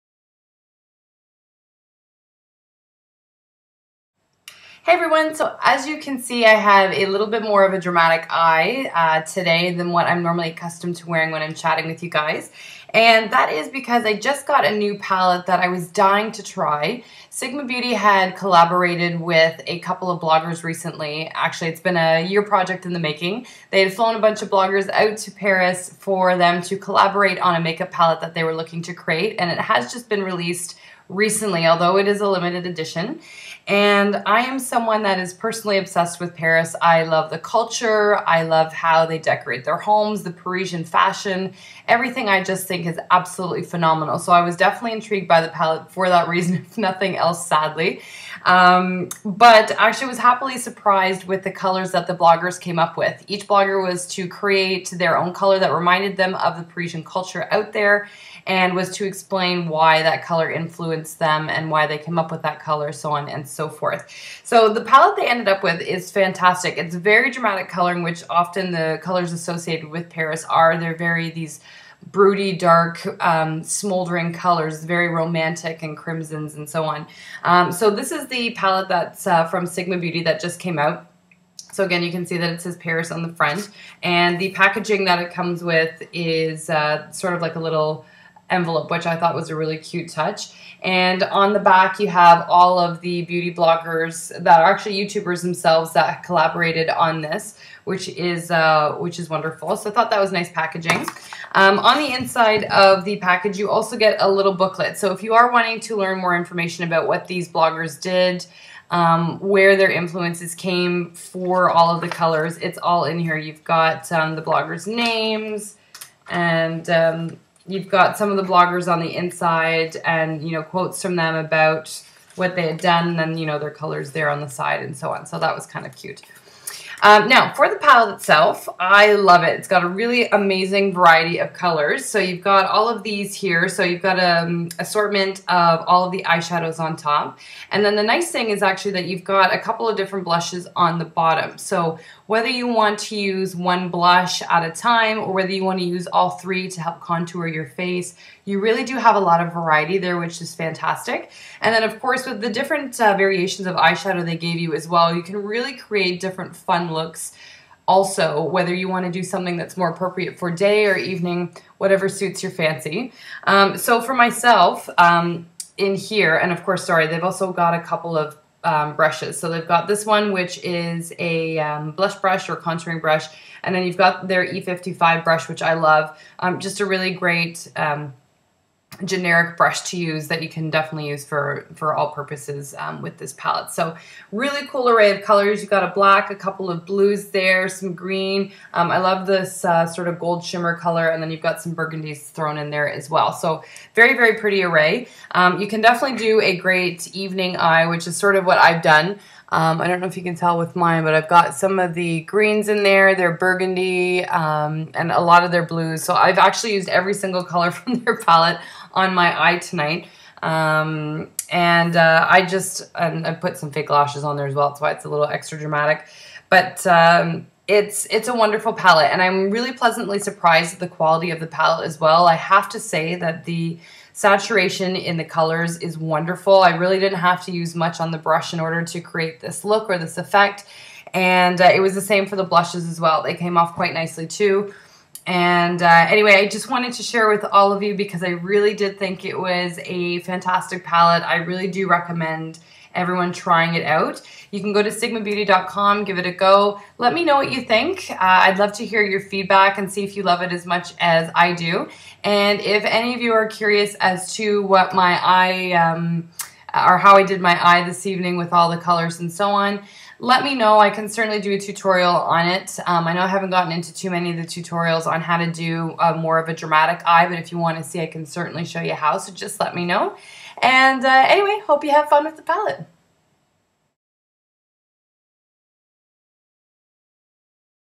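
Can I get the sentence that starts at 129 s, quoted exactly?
It's got a really amazing variety of colors.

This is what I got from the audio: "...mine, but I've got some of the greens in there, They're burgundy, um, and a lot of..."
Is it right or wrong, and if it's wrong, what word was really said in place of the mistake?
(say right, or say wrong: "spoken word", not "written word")
right.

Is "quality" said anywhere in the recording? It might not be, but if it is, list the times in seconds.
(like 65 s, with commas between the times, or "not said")
220 s.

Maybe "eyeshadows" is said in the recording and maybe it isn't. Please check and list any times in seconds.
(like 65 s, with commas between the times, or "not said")
136 s, 153 s.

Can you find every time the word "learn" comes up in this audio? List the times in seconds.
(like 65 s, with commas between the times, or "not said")
105 s.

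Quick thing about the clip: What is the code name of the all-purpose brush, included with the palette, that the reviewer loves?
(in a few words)
E55.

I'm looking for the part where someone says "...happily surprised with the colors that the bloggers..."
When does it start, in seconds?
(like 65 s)
50 s.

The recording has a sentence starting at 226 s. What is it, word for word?
I really didn't have to use much on the brush in order to create this look or this effect.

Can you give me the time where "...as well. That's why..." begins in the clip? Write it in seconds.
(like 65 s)
214 s.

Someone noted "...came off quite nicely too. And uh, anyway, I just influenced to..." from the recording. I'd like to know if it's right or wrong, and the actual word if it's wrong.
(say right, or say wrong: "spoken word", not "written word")
wrong: "wanted", not "influenced".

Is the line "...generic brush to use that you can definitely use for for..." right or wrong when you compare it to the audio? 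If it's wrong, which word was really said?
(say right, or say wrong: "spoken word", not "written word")
right.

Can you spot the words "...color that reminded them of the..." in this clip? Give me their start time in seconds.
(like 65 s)
55 s.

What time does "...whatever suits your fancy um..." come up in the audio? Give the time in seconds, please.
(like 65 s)
161 s.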